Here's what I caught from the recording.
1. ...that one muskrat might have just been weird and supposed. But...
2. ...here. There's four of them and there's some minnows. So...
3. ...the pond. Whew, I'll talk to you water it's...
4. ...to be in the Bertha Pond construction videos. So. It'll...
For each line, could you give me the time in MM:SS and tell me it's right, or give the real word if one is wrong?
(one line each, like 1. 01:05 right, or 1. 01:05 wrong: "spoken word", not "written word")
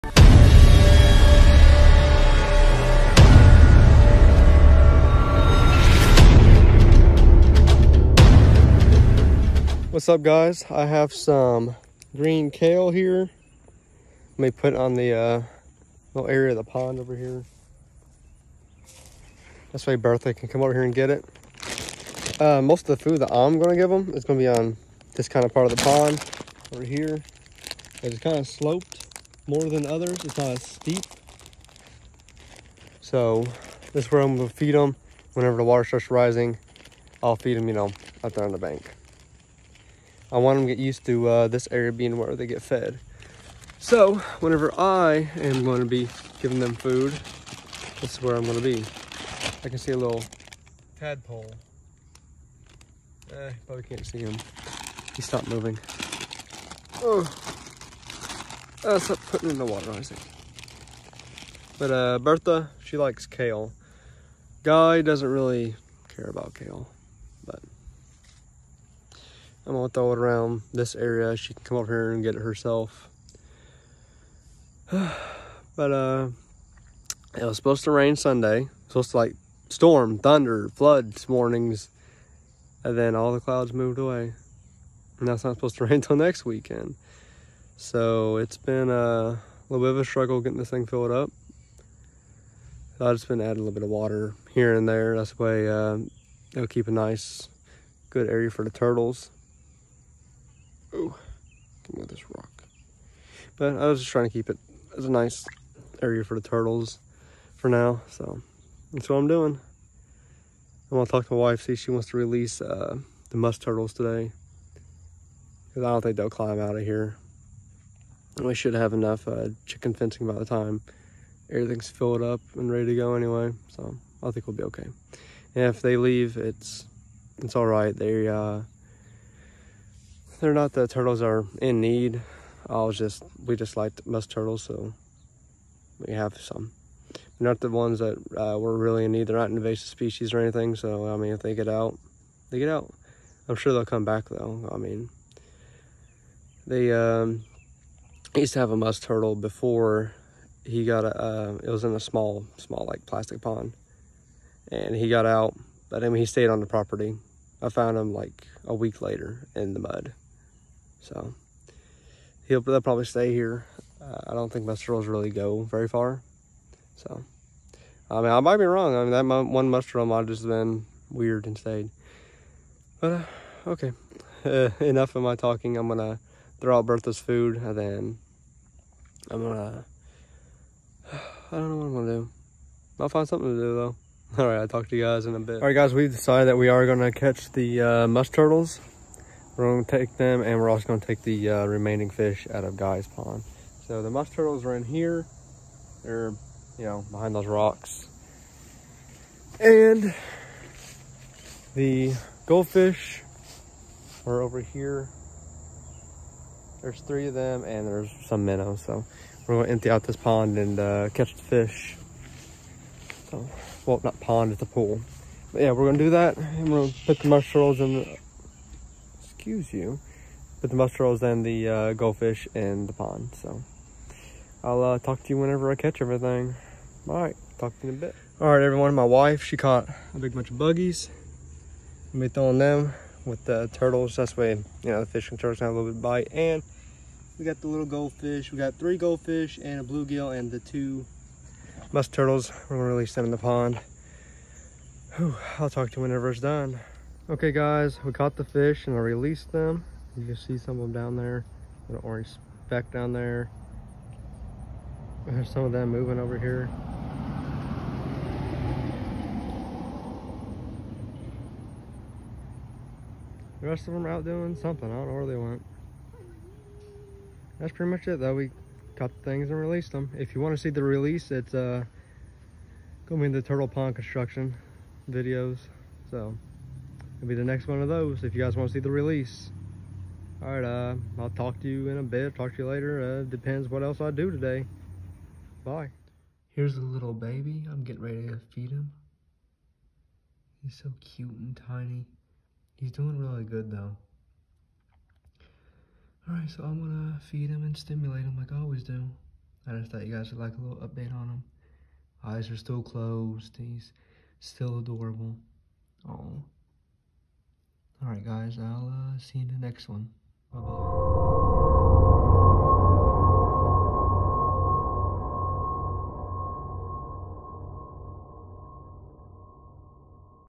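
1. 02:49 wrong: "stayed", not "supposed"
2. 03:24 wrong: "three", not "four"
3. 04:03 wrong: "whenever", not "water"
4. 04:33 wrong: "Turtle", not "Bertha".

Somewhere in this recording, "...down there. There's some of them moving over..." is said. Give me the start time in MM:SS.
04:12.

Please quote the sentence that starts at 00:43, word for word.
So whenever I am going to be giving them food, this is where I'm going to be.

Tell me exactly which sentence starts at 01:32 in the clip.
So I've just been adding a little bit of water here and there.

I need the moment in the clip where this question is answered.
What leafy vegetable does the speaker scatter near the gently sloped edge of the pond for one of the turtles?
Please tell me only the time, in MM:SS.
00:12.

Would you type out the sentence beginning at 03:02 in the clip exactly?
I'll find something to do though.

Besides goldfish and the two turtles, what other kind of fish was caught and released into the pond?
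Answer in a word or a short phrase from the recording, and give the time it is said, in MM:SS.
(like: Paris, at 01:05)
bluegill, at 03:59.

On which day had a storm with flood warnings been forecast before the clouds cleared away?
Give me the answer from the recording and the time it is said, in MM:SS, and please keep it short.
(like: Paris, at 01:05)
Sunday, at 01:18.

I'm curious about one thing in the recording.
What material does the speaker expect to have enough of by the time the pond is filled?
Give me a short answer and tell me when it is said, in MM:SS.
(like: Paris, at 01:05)
chicken fencing, at 01:59.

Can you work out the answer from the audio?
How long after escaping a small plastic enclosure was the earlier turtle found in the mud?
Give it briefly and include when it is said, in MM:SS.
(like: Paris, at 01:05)
a week later, at 02:38.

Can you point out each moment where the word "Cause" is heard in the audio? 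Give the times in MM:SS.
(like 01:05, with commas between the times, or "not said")
01:55.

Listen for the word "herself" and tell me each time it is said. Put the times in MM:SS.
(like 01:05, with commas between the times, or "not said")
01:12.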